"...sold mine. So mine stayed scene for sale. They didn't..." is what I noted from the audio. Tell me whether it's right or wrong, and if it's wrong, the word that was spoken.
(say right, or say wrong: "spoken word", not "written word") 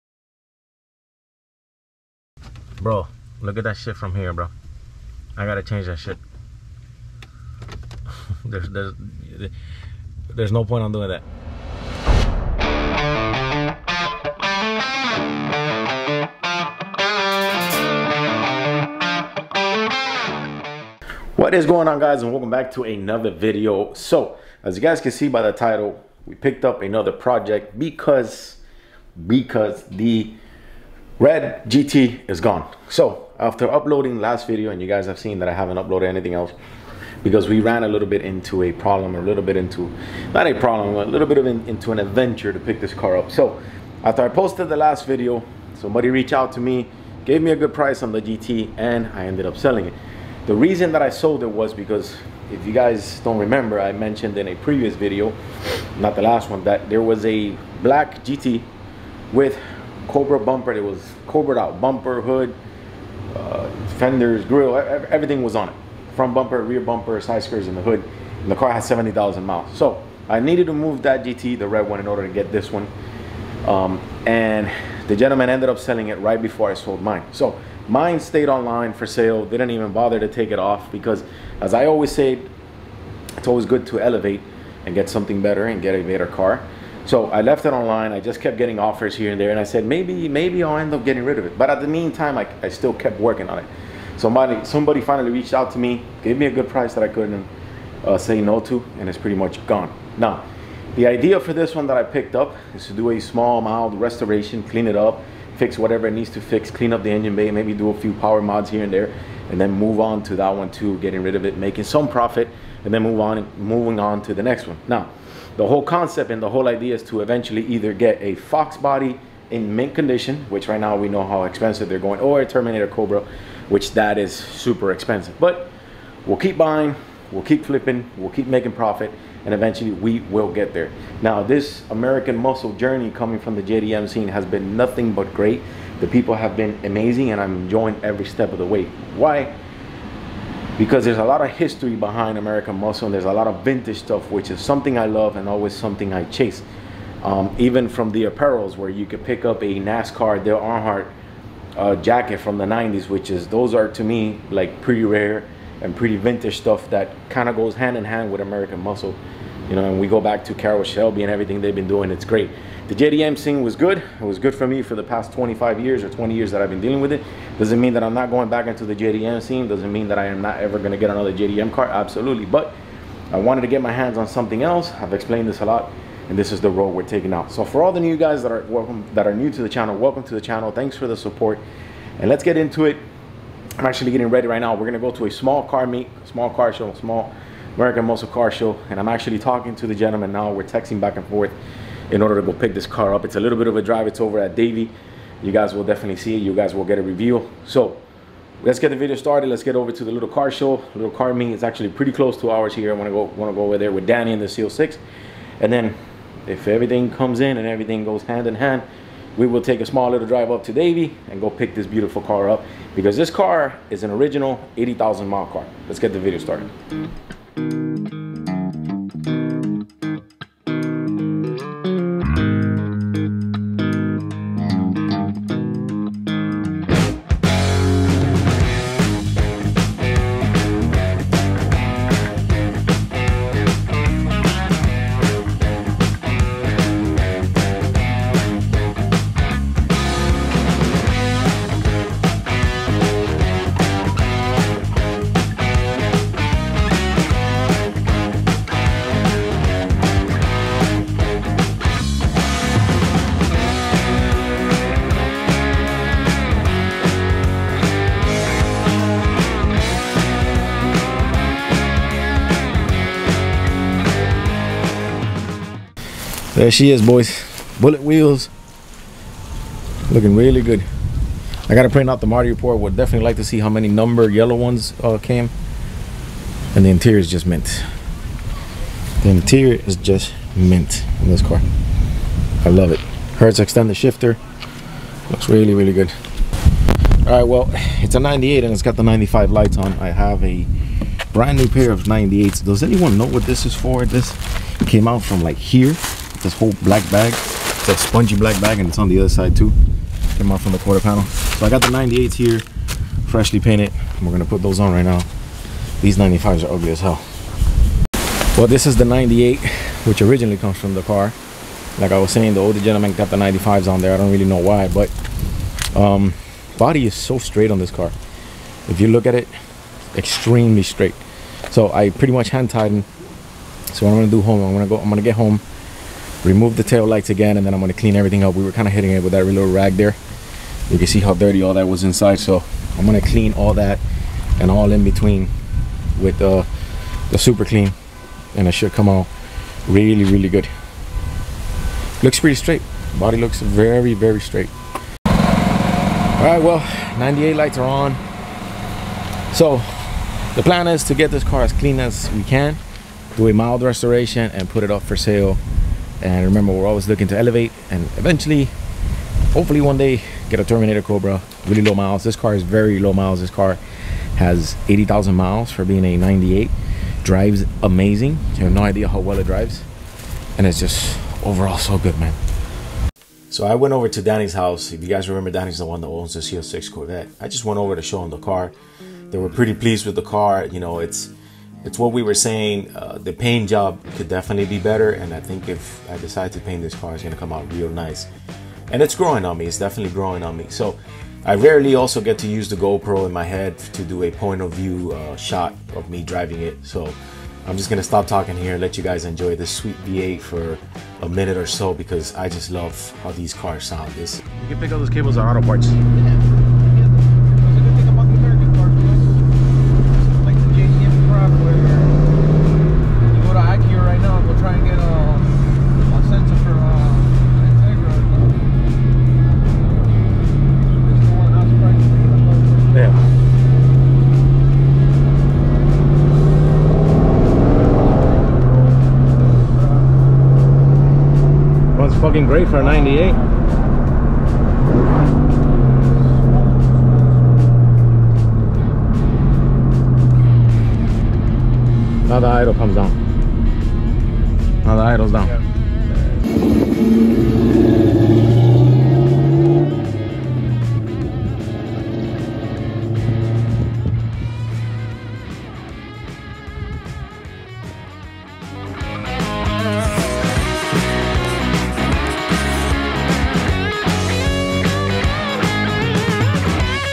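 wrong: "online", not "scene".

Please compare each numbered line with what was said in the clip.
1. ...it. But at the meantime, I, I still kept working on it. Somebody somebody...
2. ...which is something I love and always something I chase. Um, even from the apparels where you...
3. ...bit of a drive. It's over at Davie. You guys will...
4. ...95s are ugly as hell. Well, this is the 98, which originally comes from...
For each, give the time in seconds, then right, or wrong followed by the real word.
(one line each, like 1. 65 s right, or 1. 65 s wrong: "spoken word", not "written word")
1. 91 s right
2. 144 s right
3. 193 s right
4. 306 s right.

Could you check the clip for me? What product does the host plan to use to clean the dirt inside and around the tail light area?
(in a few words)
Super Clean.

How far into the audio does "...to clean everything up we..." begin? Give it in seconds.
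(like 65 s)
327 s.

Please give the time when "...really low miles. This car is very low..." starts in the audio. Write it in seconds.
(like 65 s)
361 s.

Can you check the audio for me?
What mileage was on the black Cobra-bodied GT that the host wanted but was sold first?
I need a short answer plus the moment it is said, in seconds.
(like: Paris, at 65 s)
70,000 miles, at 68 s.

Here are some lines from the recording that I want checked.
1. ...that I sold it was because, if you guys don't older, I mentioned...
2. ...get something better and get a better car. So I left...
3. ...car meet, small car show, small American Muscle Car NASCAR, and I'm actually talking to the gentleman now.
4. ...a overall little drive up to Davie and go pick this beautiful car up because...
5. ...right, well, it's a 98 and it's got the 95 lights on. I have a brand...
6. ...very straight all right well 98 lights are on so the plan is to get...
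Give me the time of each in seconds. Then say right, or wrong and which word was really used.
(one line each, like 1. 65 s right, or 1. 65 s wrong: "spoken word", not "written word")
1. 50 s wrong: "remember", not "older"
2. 84 s right
3. 185 s wrong: "Show", not "NASCAR"
4. 209 s wrong: "small", not "overall"
5. 287 s right
6. 344 s right.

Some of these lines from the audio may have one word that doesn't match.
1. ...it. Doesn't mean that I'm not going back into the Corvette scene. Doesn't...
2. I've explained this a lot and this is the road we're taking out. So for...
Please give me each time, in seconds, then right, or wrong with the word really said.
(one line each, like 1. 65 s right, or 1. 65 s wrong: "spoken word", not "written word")
1. 167 s wrong: "JDM", not "Corvette"
2. 174 s right.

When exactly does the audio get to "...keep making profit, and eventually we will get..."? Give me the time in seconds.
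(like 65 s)
128 s.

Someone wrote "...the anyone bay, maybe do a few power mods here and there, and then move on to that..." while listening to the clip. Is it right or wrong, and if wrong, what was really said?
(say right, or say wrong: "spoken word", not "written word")
wrong: "engine", not "anyone".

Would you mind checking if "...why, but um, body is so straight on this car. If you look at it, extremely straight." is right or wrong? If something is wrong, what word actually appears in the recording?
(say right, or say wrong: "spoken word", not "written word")
right.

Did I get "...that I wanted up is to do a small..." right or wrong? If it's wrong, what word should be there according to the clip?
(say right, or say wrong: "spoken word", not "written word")
wrong: "picked", not "wanted".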